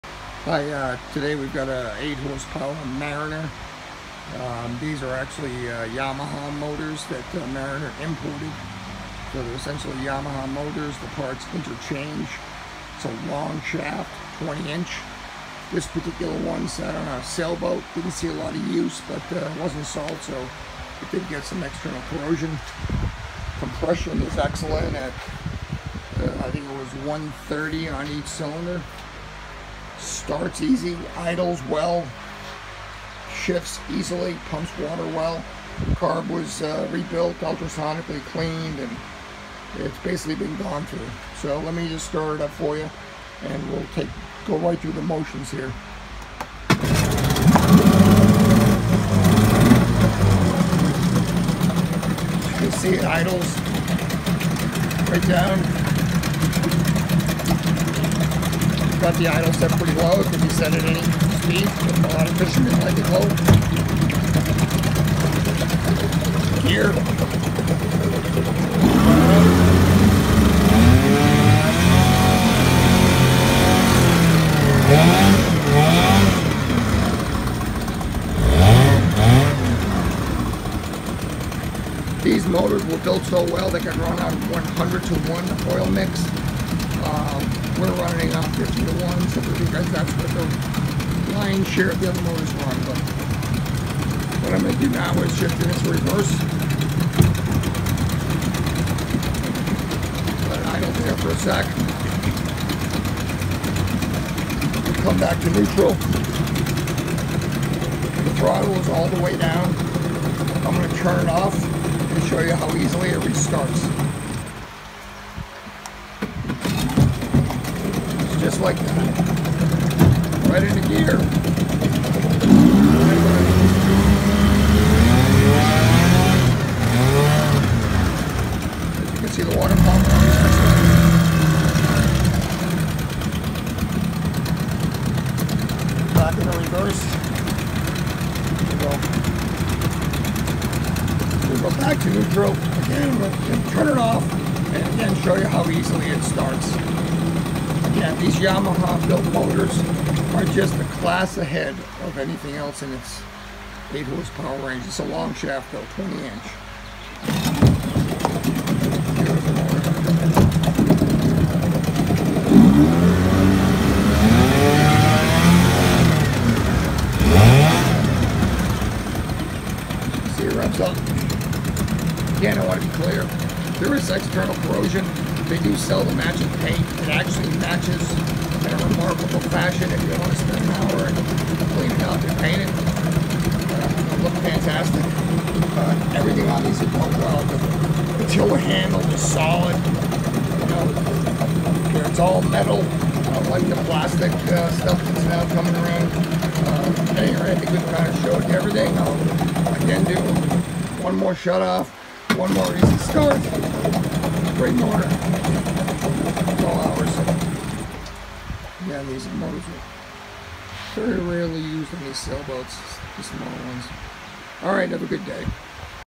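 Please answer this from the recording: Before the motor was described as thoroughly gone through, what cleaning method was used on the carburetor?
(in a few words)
ultrasonically cleaned.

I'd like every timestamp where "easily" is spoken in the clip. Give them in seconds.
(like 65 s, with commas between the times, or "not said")
33 s, 112 s, 145 s.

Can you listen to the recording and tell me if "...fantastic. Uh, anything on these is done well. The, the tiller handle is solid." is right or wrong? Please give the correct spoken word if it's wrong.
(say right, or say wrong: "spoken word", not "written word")
wrong: "everything", not "anything".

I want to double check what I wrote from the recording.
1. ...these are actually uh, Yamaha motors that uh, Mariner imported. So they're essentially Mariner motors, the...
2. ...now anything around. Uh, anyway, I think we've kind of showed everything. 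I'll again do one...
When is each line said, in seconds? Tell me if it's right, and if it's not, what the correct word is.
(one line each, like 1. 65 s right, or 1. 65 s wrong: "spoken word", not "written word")
1. 4 s wrong: "Yamaha", not "Mariner"
2. 195 s wrong: "coming", not "anything".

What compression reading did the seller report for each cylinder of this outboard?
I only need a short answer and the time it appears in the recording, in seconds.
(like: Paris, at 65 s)
130, at 27 s.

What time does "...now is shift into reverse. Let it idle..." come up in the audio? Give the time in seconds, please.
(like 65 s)
94 s.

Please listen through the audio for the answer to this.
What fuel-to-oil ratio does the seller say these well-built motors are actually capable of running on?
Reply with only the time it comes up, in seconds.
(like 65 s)
84 s.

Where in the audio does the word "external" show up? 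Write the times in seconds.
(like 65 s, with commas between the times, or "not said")
21 s, 174 s.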